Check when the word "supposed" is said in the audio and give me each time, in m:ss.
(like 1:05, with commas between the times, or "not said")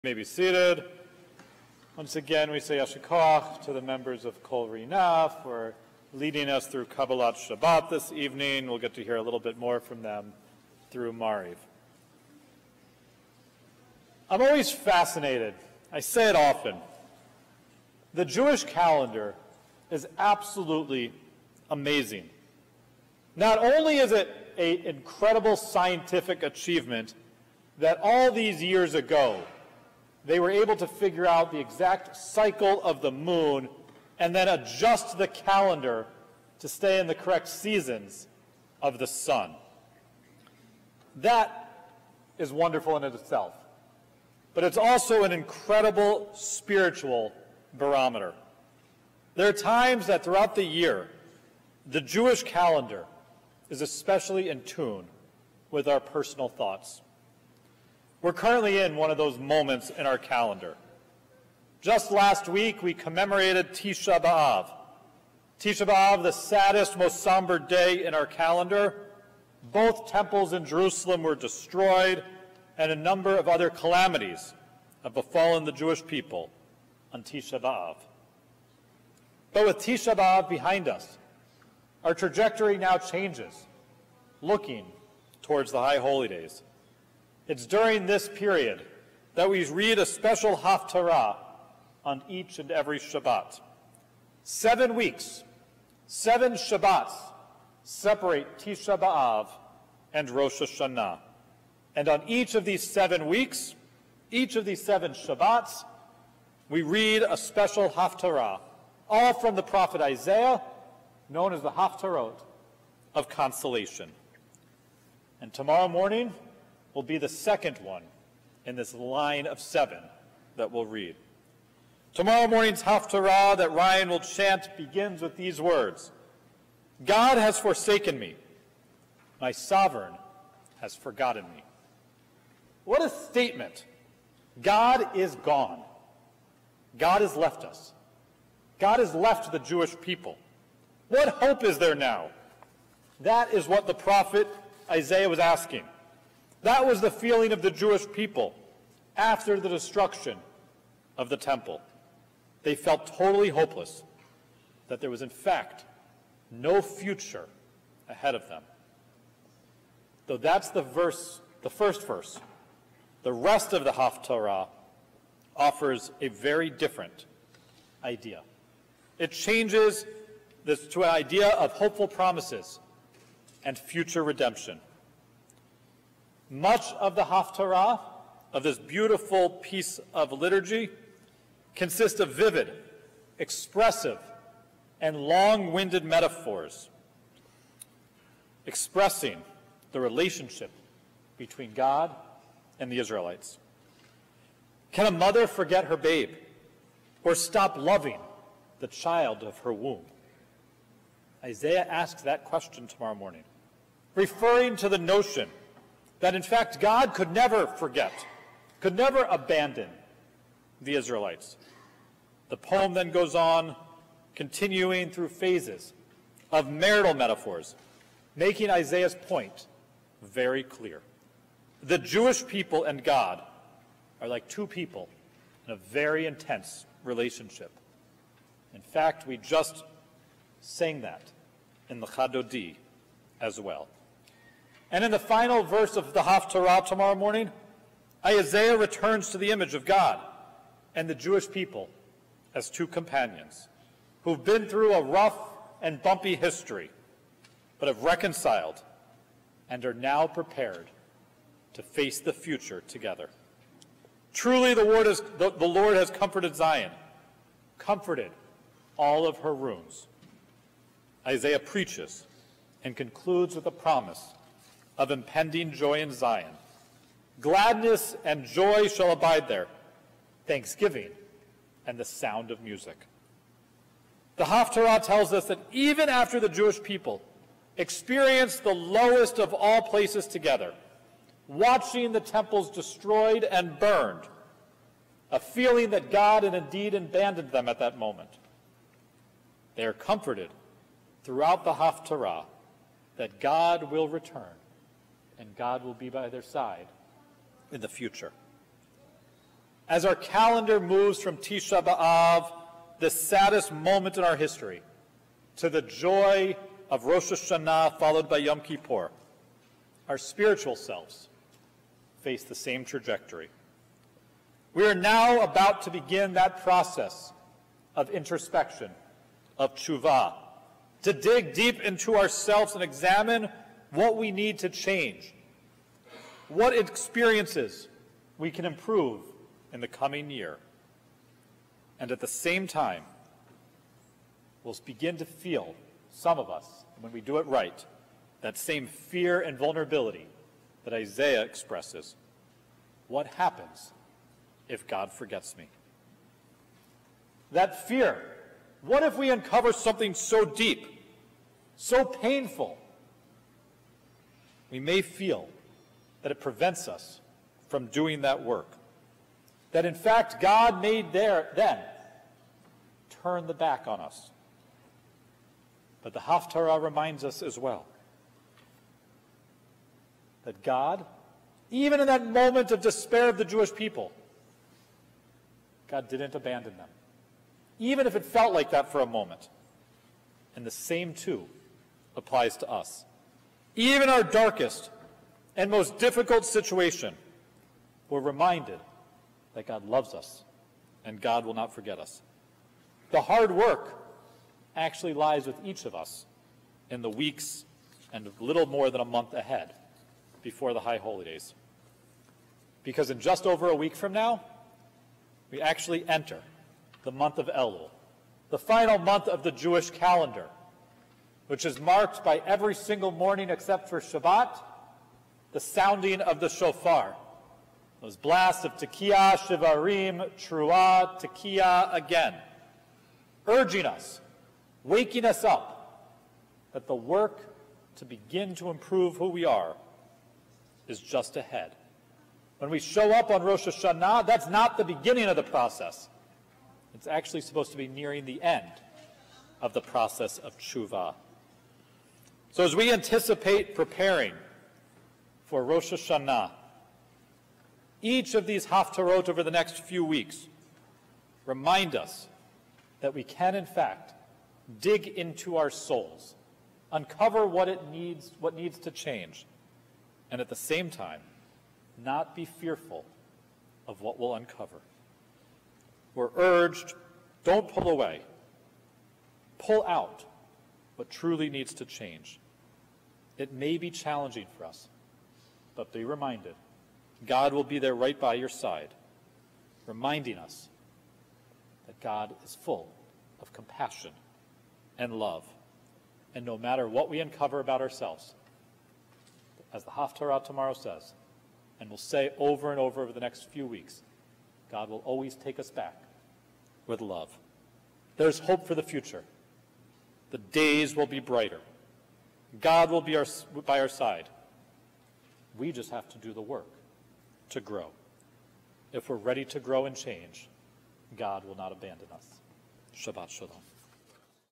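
7:17.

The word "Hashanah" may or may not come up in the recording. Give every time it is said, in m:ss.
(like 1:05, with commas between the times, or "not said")
1:40, 5:07, 7:13, 7:25.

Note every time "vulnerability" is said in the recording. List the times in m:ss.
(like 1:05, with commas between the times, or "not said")
5:39.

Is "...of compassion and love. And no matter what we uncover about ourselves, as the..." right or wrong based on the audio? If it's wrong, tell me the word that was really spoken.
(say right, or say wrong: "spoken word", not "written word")
right.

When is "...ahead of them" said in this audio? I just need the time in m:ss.
2:38.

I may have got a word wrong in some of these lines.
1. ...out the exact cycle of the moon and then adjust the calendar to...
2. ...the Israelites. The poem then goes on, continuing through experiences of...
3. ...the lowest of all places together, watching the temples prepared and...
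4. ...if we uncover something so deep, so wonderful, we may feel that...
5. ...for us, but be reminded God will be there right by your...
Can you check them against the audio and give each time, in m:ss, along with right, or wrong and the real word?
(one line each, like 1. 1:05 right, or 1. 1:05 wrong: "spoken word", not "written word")
1. 0:31 right
2. 3:30 wrong: "phases", not "experiences"
3. 4:38 wrong: "destroyed", not "prepared"
4. 5:49 wrong: "painful", not "wonderful"
5. 7:54 right.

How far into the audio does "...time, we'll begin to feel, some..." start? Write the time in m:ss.
5:32.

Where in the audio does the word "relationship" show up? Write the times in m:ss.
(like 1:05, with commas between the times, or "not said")
3:10, 3:47.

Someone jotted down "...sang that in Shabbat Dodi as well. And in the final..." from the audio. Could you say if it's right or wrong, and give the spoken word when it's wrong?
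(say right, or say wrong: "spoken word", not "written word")
wrong: "Lecha", not "Shabbat".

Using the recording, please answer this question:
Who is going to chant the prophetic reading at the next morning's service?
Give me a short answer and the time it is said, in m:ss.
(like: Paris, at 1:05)
Ryan, at 2:03.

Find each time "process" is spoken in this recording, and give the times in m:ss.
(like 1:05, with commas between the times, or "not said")
5:16, 7:15, 7:19.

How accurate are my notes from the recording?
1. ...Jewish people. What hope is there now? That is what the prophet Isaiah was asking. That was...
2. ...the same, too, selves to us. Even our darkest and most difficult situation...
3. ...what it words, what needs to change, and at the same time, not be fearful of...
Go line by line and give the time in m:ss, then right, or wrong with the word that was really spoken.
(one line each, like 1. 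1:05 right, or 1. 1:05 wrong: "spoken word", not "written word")
1. 2:19 right
2. 6:20 wrong: "applies", not "selves"
3. 7:37 wrong: "needs", not "words".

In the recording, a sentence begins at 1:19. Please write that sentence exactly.
But with Tisha B'Av behind us, our trajectory now changes, looking towards the High Holy Days.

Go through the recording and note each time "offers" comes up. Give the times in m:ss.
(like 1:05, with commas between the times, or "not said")
2:45.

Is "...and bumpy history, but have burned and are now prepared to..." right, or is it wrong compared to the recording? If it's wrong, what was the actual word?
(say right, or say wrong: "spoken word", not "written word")
wrong: "reconciled", not "burned".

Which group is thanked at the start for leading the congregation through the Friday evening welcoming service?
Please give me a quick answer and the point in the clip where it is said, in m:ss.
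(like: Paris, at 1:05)
Kol Rinah, at 0:04.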